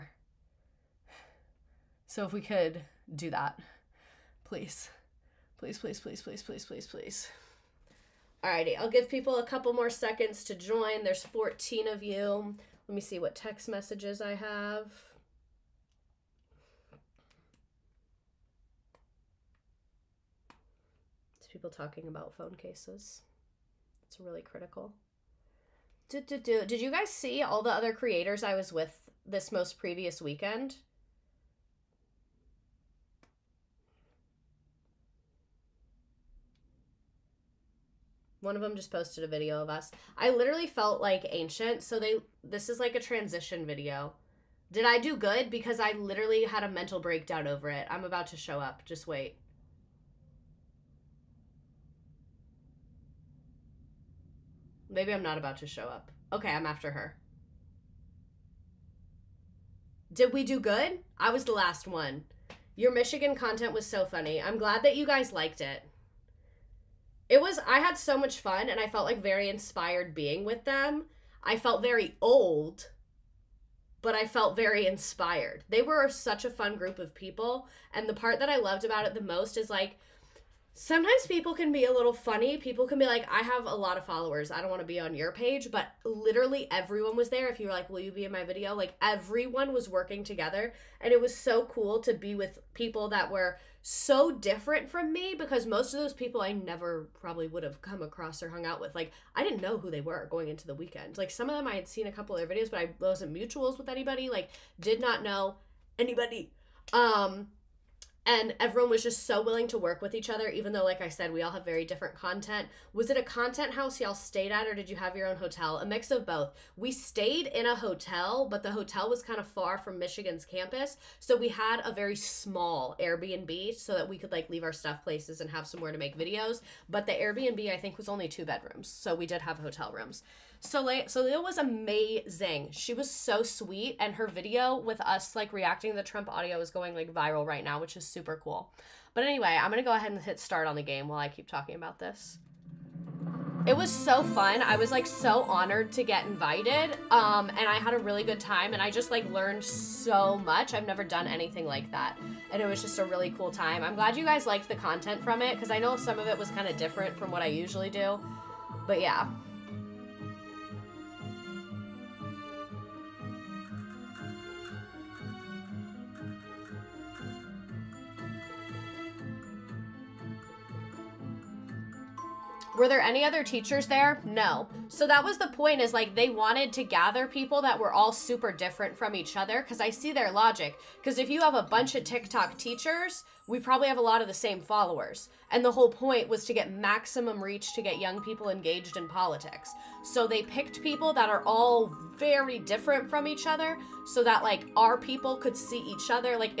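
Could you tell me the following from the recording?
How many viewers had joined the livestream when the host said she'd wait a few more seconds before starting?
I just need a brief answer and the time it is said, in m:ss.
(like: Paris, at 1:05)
14, at 0:11.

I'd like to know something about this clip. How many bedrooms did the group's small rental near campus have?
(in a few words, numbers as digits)
2.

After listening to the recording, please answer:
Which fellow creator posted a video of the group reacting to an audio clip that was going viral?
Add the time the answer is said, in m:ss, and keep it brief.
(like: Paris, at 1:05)
Soleil, at 2:11.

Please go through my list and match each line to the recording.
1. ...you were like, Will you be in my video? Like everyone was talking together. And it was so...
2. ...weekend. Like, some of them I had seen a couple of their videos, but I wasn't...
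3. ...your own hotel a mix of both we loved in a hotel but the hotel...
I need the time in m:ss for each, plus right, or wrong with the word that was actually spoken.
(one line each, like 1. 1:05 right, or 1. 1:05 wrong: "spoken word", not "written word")
1. 1:27 wrong: "working", not "talking"
2. 1:40 right
3. 1:55 wrong: "stayed", not "loved".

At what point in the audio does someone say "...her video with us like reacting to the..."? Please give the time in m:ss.
2:14.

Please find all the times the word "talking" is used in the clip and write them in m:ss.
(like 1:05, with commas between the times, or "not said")
0:21, 2:21.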